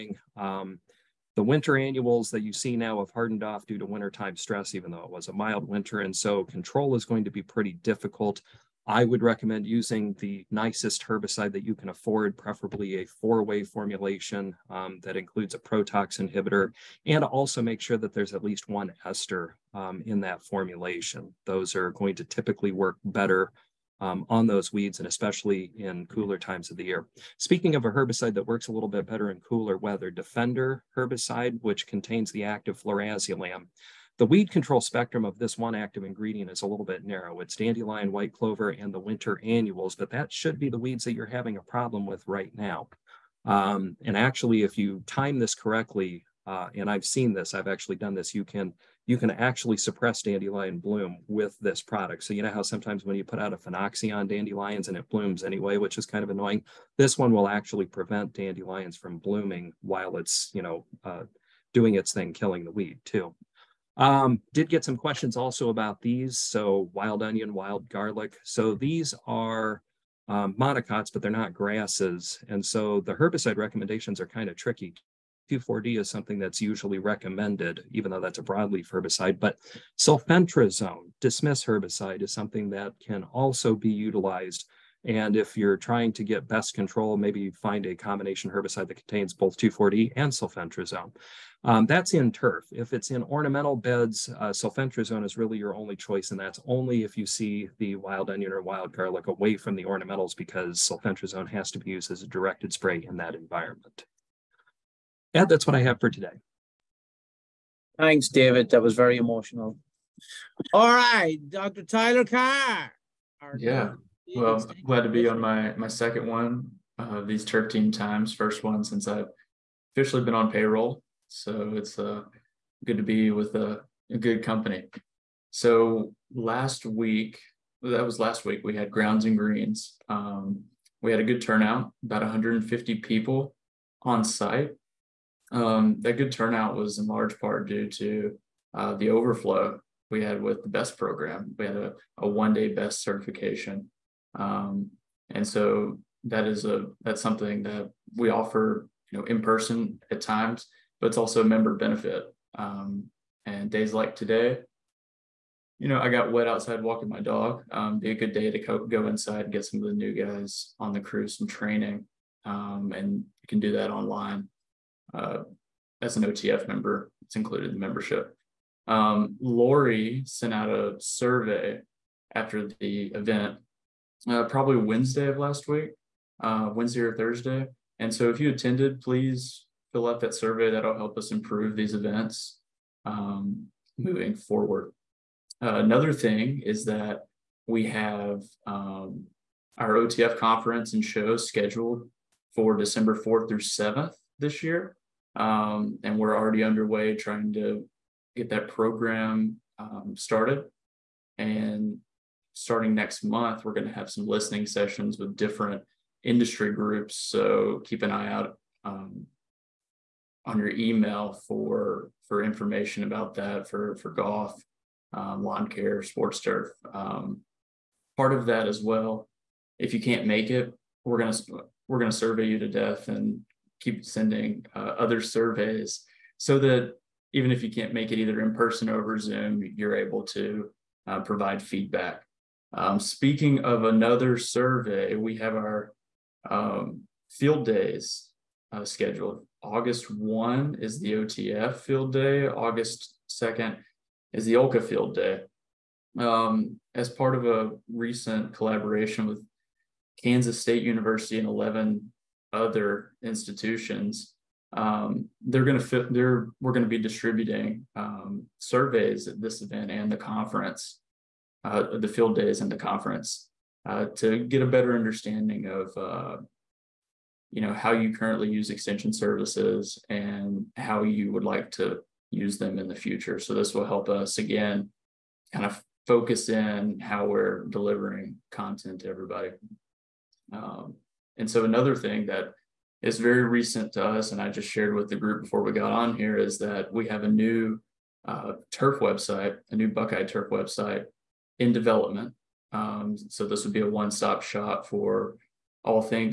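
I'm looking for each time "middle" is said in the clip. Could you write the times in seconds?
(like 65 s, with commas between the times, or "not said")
not said.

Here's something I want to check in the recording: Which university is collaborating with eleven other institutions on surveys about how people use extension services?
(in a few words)
Kansas State University.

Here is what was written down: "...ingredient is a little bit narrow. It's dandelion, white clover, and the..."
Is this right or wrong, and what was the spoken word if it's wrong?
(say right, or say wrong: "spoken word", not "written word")
right.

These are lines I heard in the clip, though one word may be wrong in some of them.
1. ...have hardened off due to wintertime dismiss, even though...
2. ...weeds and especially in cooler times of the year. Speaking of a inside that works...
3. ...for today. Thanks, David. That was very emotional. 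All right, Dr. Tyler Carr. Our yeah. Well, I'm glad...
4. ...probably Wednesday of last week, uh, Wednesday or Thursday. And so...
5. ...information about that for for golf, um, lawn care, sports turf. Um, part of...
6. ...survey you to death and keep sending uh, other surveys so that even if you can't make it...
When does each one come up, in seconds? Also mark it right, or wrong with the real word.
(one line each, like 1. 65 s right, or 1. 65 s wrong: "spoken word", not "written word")
1. 2 s wrong: "stress", not "dismiss"
2. 24 s wrong: "herbicide", not "inside"
3. 105 s right
4. 174 s right
5. 212 s right
6. 222 s right.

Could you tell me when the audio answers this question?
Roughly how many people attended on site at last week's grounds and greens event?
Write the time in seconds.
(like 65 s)
132 s.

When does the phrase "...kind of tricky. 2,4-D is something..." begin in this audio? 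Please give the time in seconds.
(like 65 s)
74 s.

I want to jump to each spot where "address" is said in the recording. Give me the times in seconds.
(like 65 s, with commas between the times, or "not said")
not said.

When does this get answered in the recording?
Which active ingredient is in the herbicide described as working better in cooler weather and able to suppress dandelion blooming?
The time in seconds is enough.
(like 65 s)
32 s.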